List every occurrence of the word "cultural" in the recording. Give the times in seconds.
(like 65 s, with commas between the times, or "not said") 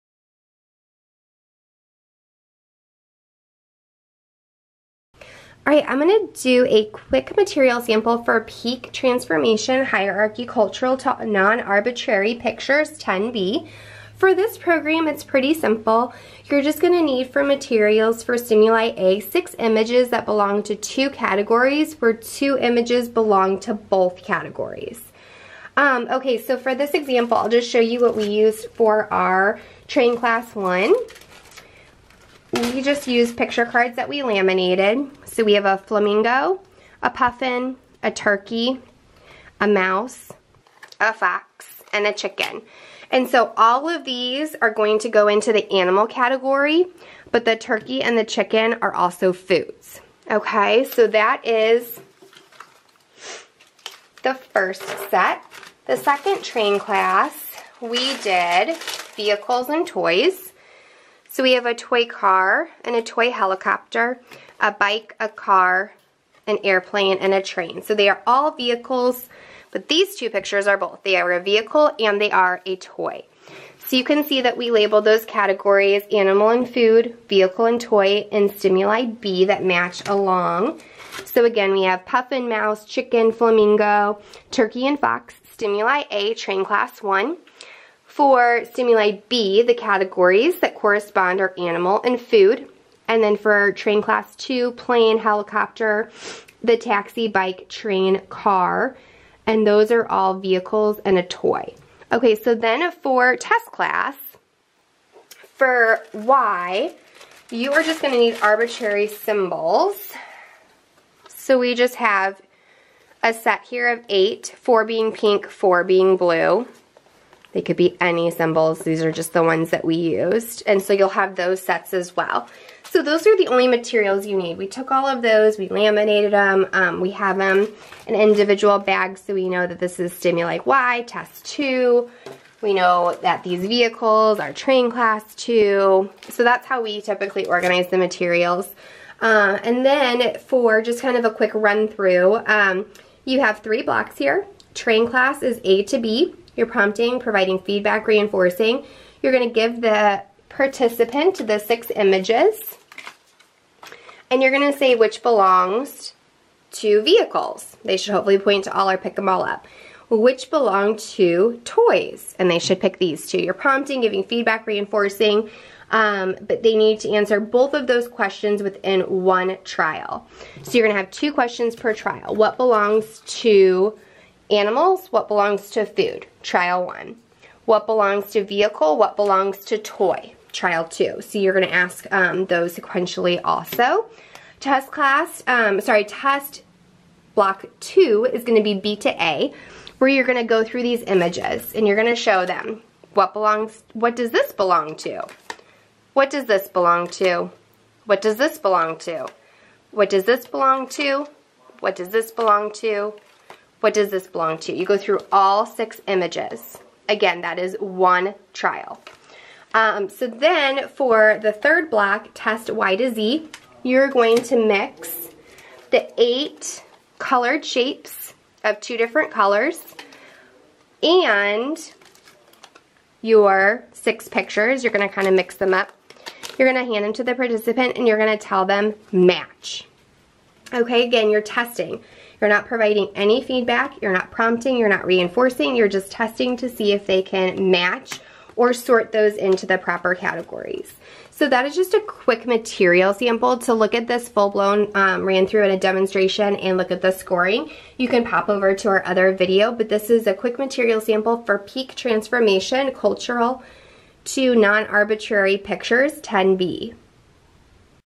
10 s, 252 s.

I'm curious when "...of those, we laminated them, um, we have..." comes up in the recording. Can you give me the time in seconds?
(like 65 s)
125 s.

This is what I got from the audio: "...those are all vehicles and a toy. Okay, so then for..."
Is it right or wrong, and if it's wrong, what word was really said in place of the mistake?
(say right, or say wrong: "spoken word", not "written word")
right.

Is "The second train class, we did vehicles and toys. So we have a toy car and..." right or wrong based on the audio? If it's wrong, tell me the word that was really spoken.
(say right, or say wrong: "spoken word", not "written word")
right.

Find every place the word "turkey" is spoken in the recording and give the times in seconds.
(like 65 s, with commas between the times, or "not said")
38 s, 47 s, 84 s.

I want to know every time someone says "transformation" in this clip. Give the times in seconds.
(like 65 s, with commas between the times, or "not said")
8 s, 251 s.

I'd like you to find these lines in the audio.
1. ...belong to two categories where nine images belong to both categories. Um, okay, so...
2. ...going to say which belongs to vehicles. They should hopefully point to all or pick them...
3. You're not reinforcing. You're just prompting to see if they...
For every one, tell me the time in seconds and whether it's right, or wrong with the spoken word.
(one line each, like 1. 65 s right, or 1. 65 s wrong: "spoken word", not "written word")
1. 20 s wrong: "two", not "nine"
2. 154 s right
3. 234 s wrong: "testing", not "prompting".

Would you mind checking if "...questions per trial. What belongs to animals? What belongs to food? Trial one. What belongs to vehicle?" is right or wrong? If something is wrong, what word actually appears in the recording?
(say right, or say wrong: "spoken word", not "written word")
right.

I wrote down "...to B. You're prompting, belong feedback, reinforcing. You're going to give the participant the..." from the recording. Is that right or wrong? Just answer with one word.
wrong.